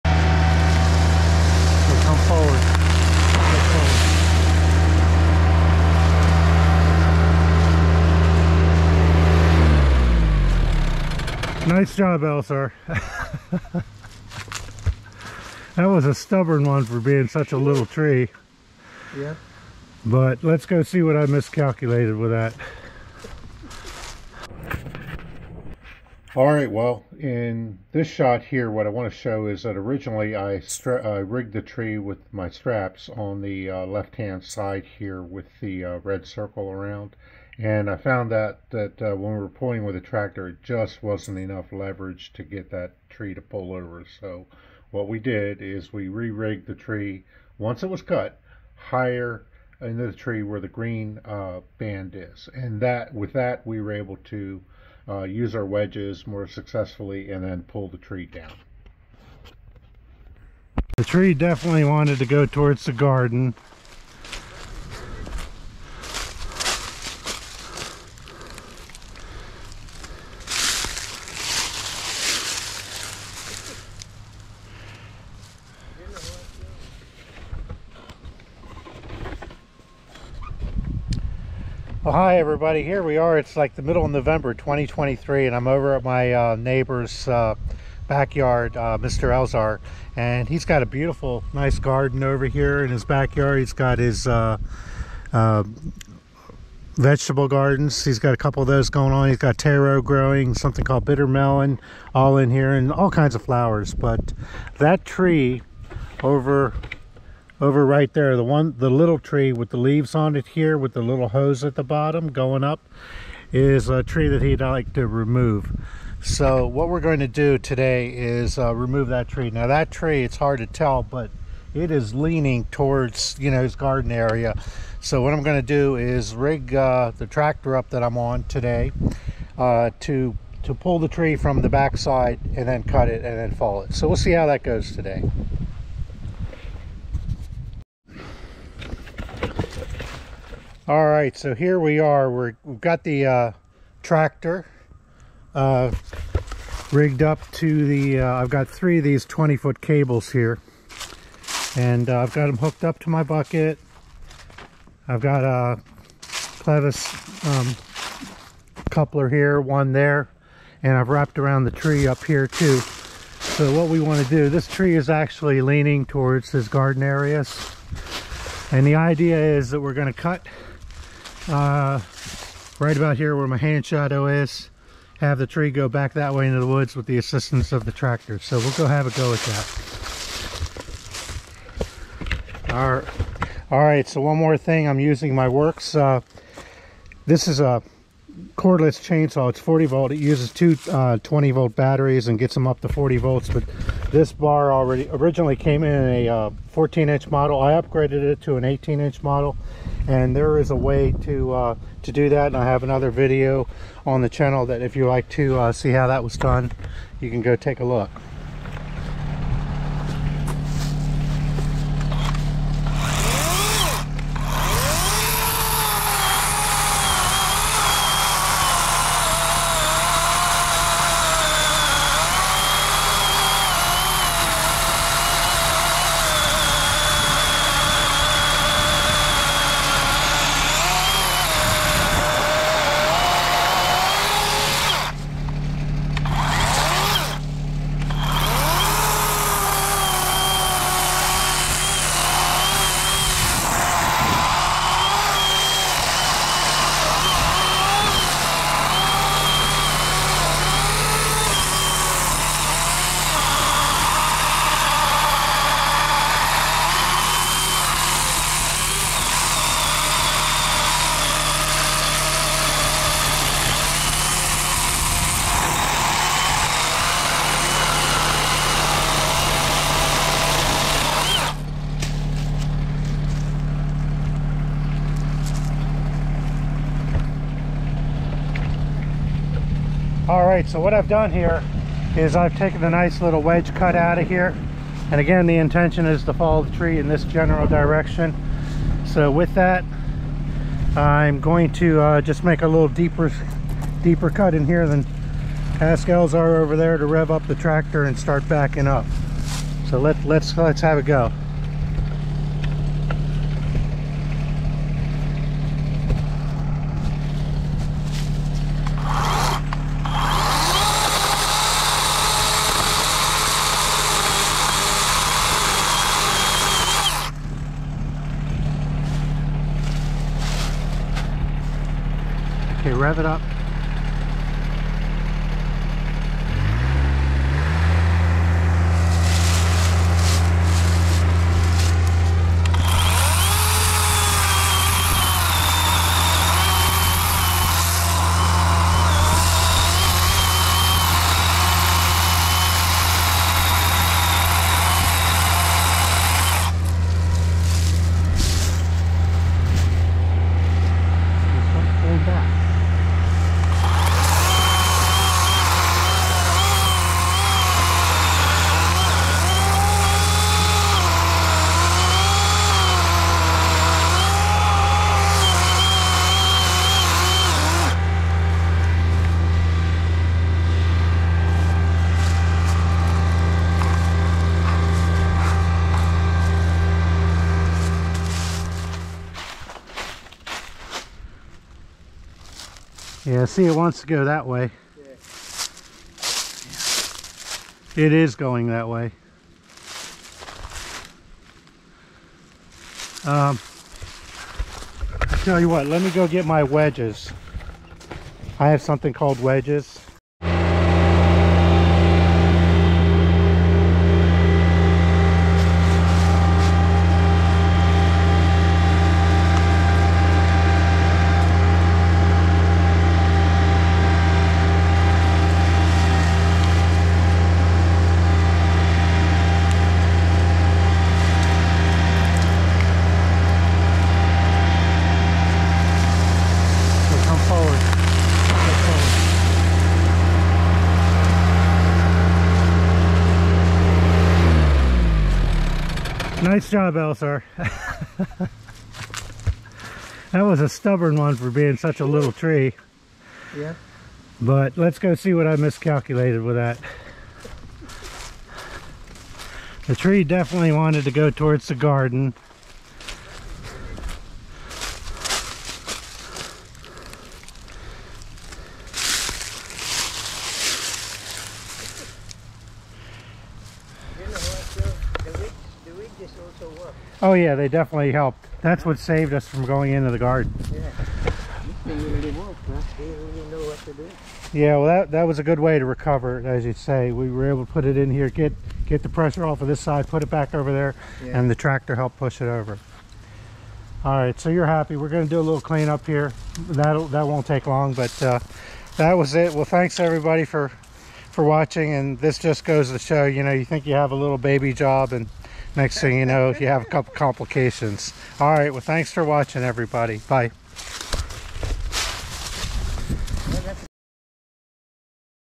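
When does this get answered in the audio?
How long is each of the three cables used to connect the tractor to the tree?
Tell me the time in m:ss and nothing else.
2:29.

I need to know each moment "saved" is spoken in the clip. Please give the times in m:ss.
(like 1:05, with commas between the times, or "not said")
7:48.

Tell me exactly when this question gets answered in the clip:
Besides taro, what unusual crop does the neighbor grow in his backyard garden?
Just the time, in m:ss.
1:41.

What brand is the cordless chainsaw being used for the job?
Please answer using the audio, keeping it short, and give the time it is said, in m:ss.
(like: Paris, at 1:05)
Worx, at 3:05.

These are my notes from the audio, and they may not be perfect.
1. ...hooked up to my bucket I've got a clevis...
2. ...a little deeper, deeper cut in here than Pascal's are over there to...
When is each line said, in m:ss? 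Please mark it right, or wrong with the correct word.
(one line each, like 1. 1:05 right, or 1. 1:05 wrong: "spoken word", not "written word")
1. 2:32 right
2. 4:52 right.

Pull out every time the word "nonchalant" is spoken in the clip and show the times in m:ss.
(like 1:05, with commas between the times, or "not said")
not said.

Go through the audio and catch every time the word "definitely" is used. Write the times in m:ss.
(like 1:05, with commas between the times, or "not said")
1:01, 7:30, 7:47.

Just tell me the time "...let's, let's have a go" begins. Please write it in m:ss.
5:00.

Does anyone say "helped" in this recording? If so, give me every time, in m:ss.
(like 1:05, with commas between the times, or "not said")
7:48, 8:01.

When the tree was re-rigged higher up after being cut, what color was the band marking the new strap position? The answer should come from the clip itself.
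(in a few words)
Green.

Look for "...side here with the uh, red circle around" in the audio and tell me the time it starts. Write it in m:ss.
0:34.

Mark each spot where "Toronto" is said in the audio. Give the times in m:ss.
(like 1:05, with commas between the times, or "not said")
not said.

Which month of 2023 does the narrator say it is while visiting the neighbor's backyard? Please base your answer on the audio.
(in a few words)
November.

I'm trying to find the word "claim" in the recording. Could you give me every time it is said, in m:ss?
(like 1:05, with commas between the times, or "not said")
not said.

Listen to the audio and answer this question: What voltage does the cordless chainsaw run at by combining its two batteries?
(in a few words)
40 volts.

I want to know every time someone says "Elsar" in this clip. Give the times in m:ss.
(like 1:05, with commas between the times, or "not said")
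0:12, 7:16.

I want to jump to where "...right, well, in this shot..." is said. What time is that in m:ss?
0:26.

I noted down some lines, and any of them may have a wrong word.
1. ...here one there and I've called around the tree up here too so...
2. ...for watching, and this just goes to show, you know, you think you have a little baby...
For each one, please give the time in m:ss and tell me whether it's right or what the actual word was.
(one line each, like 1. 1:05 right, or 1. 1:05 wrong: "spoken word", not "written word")
1. 2:39 wrong: "wrapped", not "called"
2. 8:11 right.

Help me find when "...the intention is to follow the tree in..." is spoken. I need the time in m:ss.
4:45.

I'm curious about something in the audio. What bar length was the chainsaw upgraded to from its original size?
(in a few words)
18 inch.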